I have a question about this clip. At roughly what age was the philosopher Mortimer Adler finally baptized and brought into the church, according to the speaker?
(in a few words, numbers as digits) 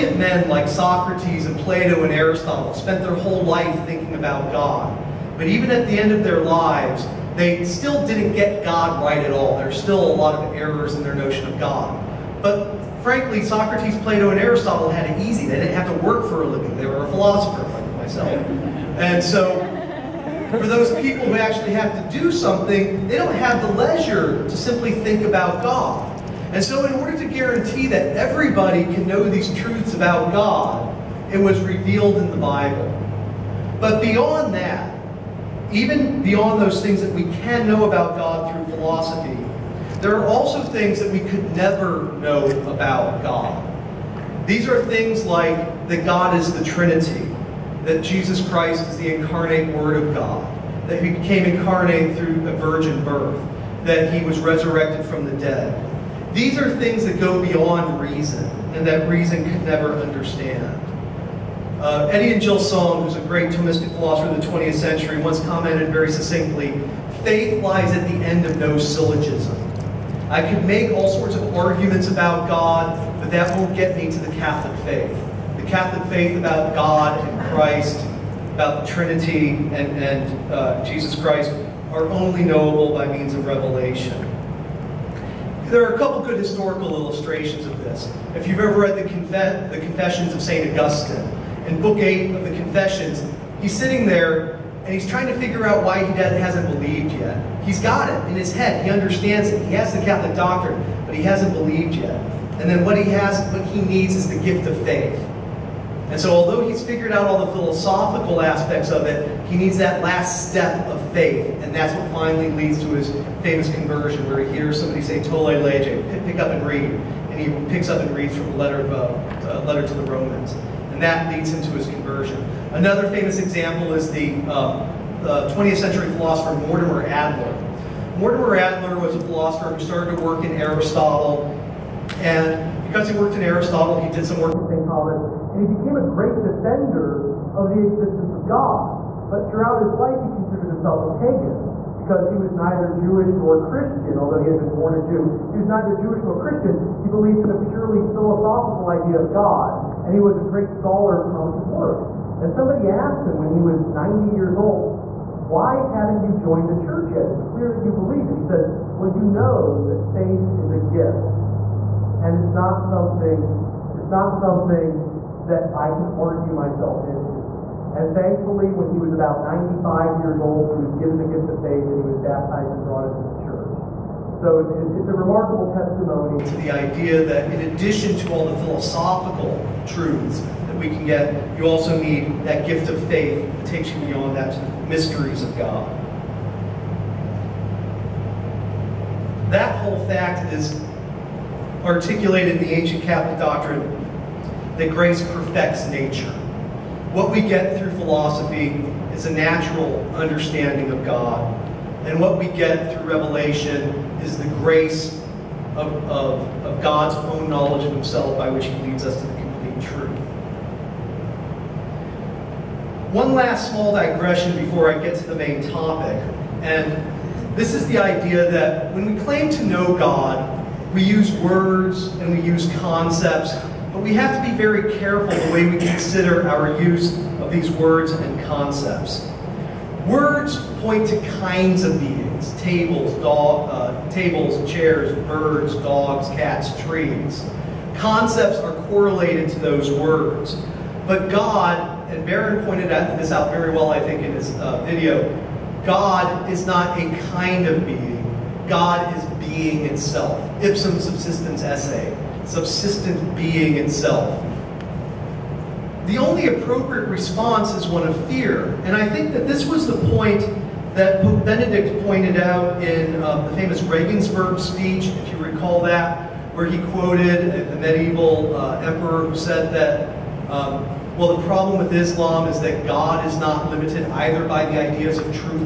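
95.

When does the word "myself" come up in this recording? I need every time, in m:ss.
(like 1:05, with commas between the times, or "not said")
0:17, 2:46.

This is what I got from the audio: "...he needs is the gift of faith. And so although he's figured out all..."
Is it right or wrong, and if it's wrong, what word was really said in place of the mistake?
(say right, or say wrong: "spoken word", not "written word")
right.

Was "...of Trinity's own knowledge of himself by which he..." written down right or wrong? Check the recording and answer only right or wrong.
wrong.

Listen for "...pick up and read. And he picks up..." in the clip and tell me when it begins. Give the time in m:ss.
1:56.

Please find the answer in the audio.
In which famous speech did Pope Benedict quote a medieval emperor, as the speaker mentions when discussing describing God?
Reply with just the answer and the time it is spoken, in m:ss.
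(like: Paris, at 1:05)
Regensburg speech, at 4:23.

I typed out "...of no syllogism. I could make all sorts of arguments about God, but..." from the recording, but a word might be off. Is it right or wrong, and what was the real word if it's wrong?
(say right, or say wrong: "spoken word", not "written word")
right.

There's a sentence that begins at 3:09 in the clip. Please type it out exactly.
That whole fact is articulated in the ancient Catholic doctrine that grace perfects nature.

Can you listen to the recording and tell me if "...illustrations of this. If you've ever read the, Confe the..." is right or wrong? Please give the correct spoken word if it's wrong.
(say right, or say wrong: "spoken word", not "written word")
right.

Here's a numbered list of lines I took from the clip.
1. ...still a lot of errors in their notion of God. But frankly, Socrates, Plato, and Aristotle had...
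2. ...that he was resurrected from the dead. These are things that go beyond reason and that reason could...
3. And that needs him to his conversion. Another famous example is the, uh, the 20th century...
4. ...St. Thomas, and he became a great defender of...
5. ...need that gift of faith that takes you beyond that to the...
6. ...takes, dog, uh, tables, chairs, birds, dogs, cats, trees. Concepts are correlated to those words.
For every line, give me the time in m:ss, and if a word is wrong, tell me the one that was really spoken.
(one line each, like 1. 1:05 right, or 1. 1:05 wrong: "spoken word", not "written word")
1. 0:09 right
2. 0:53 right
3. 2:00 wrong: "leads", not "needs"
4. 2:14 right
5. 3:02 right
6. 3:52 wrong: "tables", not "takes".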